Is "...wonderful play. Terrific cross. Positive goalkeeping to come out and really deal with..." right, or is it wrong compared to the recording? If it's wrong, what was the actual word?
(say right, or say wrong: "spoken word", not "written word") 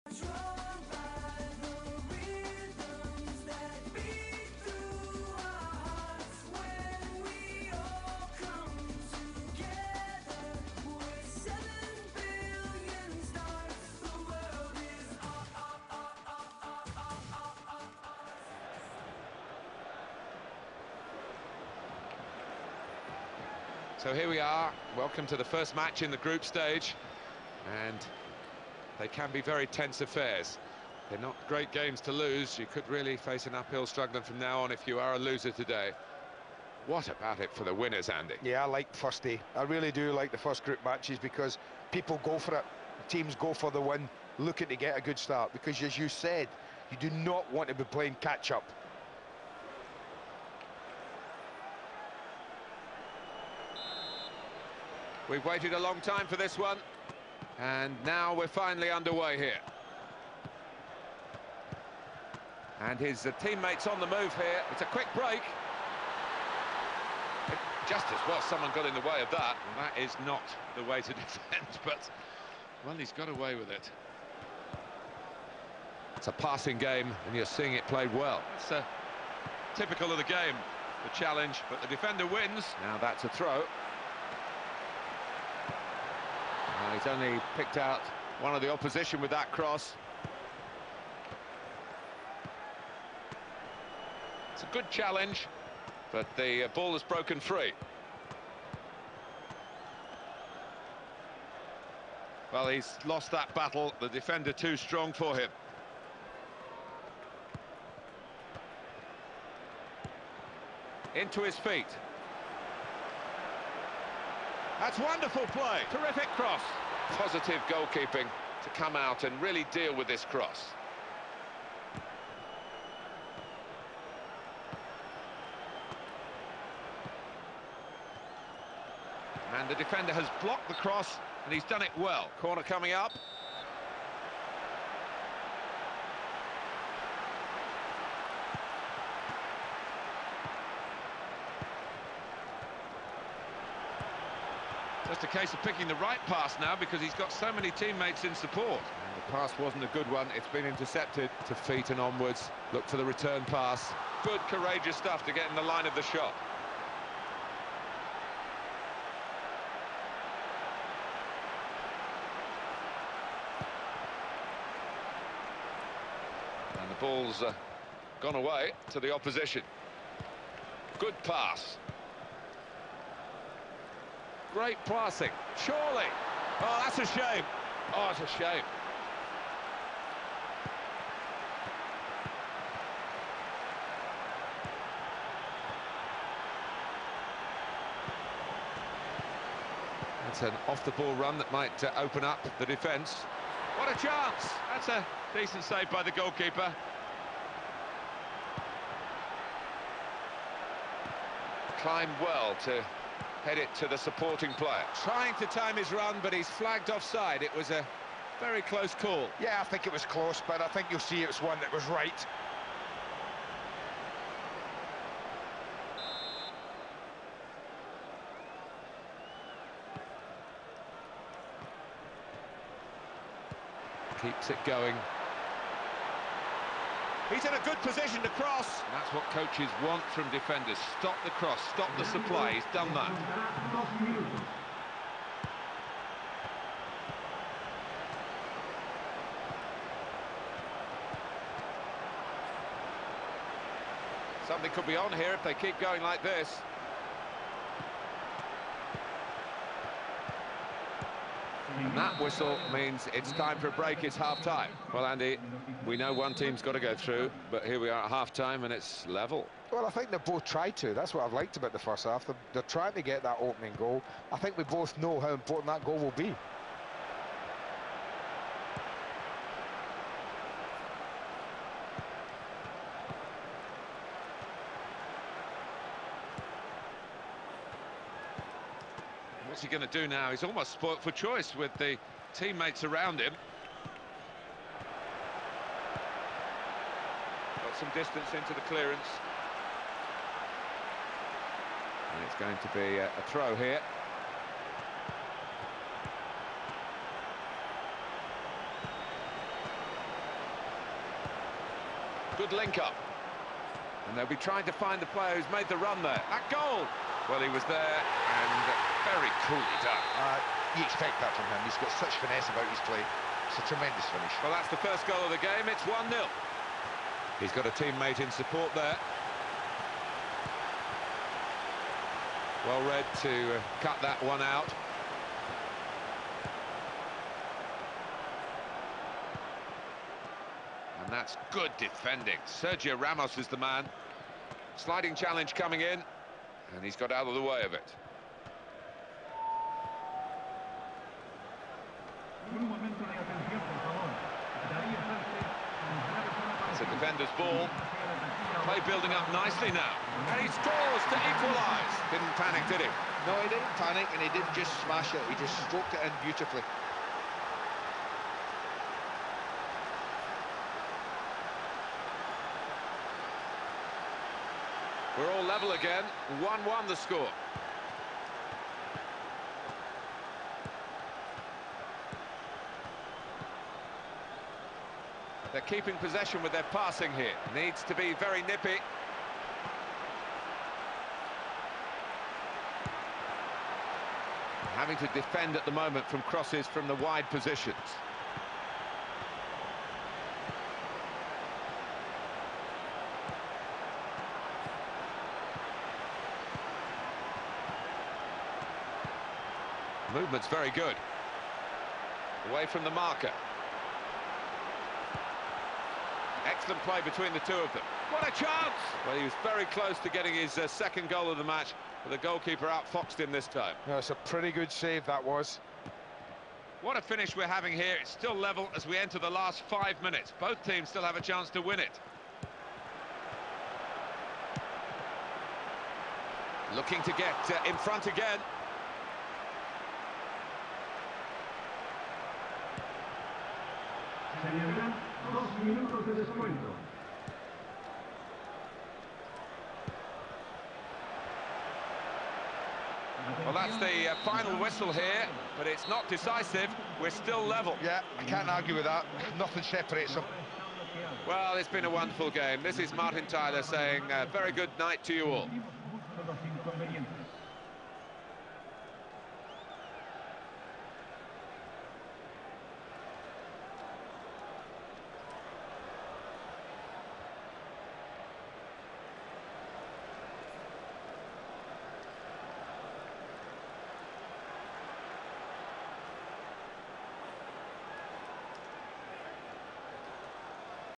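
right.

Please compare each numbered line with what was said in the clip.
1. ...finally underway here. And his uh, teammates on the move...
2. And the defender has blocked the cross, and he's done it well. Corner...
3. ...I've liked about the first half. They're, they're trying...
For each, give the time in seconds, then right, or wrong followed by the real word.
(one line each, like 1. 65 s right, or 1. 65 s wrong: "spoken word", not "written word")
1. 58 s right
2. 129 s right
3. 261 s right.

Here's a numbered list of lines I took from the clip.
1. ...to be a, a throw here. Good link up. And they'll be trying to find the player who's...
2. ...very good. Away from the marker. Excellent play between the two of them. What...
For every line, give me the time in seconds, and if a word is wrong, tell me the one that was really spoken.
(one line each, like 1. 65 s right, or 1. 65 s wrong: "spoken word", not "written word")
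1. 292 s right
2. 400 s right.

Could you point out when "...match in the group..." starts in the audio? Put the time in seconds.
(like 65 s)
25 s.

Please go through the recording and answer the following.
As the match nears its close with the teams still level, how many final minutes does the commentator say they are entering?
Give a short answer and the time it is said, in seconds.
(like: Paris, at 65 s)
5, at 419 s.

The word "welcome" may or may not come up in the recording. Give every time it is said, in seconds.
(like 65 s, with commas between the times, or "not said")
24 s.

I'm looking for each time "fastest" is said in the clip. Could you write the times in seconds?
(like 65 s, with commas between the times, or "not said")
not said.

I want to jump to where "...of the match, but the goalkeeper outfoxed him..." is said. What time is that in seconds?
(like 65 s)
411 s.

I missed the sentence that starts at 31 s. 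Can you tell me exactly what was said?
They're not great games to lose, you could really face an uphill struggle from now on if you are a loser today.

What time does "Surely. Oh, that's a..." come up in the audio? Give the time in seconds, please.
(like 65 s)
175 s.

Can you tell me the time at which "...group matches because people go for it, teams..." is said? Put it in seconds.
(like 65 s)
40 s.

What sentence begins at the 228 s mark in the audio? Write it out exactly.
And that's what coaches want from defenders.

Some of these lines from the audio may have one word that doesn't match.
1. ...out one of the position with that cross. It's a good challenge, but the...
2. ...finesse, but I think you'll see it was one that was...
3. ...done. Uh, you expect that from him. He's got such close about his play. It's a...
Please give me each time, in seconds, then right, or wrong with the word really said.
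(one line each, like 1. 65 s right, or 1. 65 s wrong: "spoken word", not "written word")
1. 87 s wrong: "opposition", not "position"
2. 210 s wrong: "close", not "finesse"
3. 309 s wrong: "finesse", not "close".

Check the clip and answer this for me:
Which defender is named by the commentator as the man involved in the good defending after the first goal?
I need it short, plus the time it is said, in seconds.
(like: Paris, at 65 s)
Sergio Ramos, at 332 s.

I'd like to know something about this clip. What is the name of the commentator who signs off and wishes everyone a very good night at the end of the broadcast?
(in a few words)
Martin Tyler.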